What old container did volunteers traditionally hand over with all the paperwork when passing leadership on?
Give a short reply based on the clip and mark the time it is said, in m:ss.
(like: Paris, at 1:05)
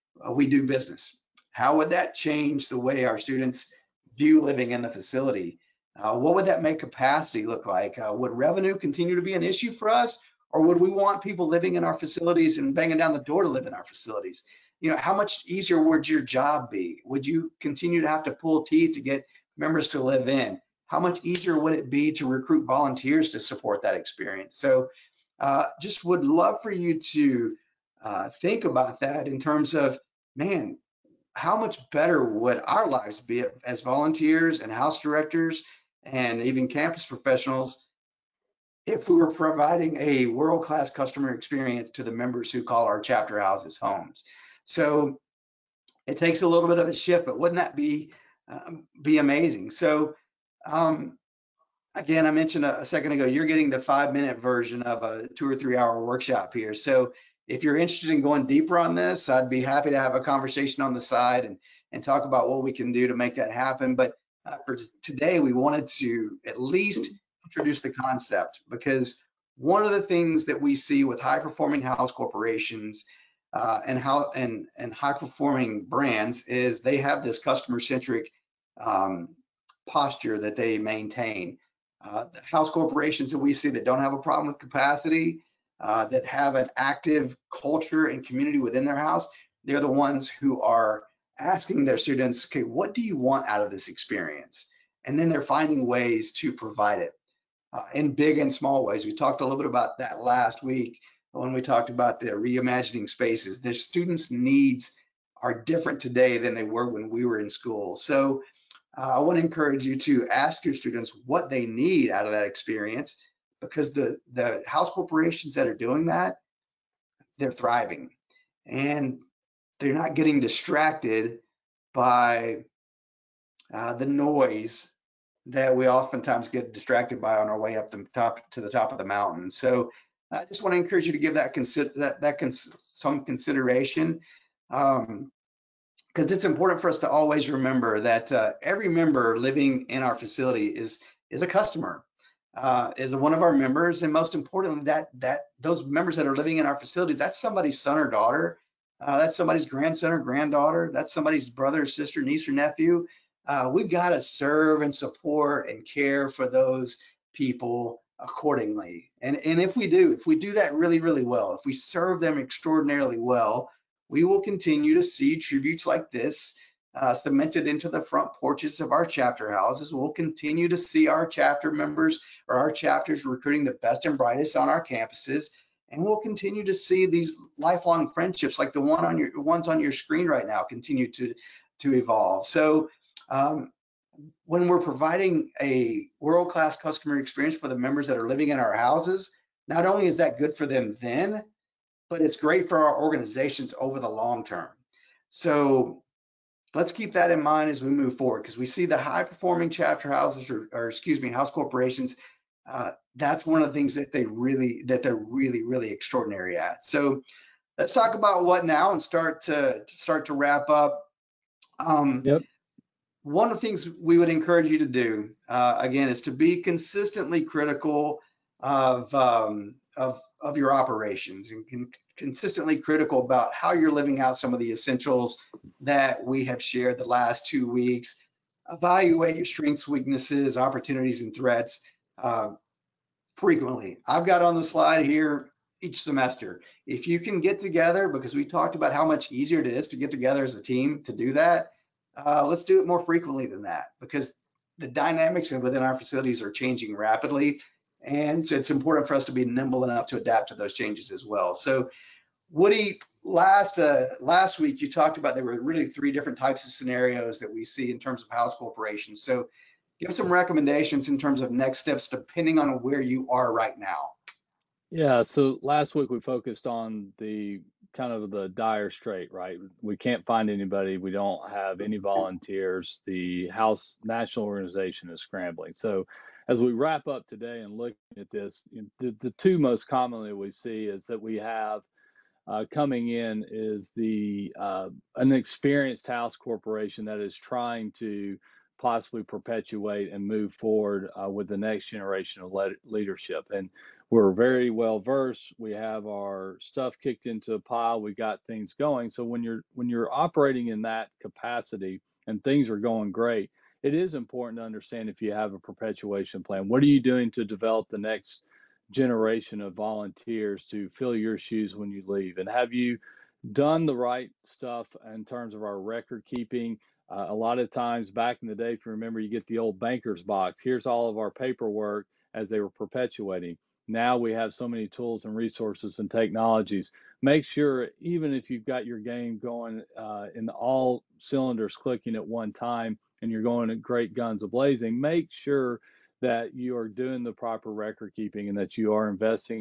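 Banker's box, at 5:19.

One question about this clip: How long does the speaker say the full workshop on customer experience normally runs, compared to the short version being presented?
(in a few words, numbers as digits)
2 or 3 hours.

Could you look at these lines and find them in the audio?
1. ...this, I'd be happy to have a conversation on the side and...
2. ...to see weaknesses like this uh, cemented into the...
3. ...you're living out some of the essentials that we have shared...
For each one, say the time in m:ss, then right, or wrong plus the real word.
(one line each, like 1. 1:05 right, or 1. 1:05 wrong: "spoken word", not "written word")
1. 0:58 right
2. 2:44 wrong: "tributes", not "weaknesses"
3. 3:43 right.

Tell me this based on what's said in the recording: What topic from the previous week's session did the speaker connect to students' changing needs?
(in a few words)
Reimagining spaces.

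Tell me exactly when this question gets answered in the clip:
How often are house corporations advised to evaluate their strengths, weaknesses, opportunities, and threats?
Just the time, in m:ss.
3:55.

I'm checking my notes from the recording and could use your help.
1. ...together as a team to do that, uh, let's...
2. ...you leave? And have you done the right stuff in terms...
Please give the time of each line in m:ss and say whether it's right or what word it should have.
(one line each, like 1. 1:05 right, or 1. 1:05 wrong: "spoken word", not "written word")
1. 4:00 right
2. 5:11 right.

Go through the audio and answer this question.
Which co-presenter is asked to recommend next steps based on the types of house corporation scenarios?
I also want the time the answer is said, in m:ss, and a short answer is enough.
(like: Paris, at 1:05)
Woody, at 4:12.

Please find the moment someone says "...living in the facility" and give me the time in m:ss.
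0:04.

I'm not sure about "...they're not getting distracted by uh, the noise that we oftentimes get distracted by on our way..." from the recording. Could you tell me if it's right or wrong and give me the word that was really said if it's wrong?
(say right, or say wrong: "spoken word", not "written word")
right.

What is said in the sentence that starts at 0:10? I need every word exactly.
Or would we want people living in our facilities and banging down the door to live in our facilities?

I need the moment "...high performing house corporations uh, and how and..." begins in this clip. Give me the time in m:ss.
1:11.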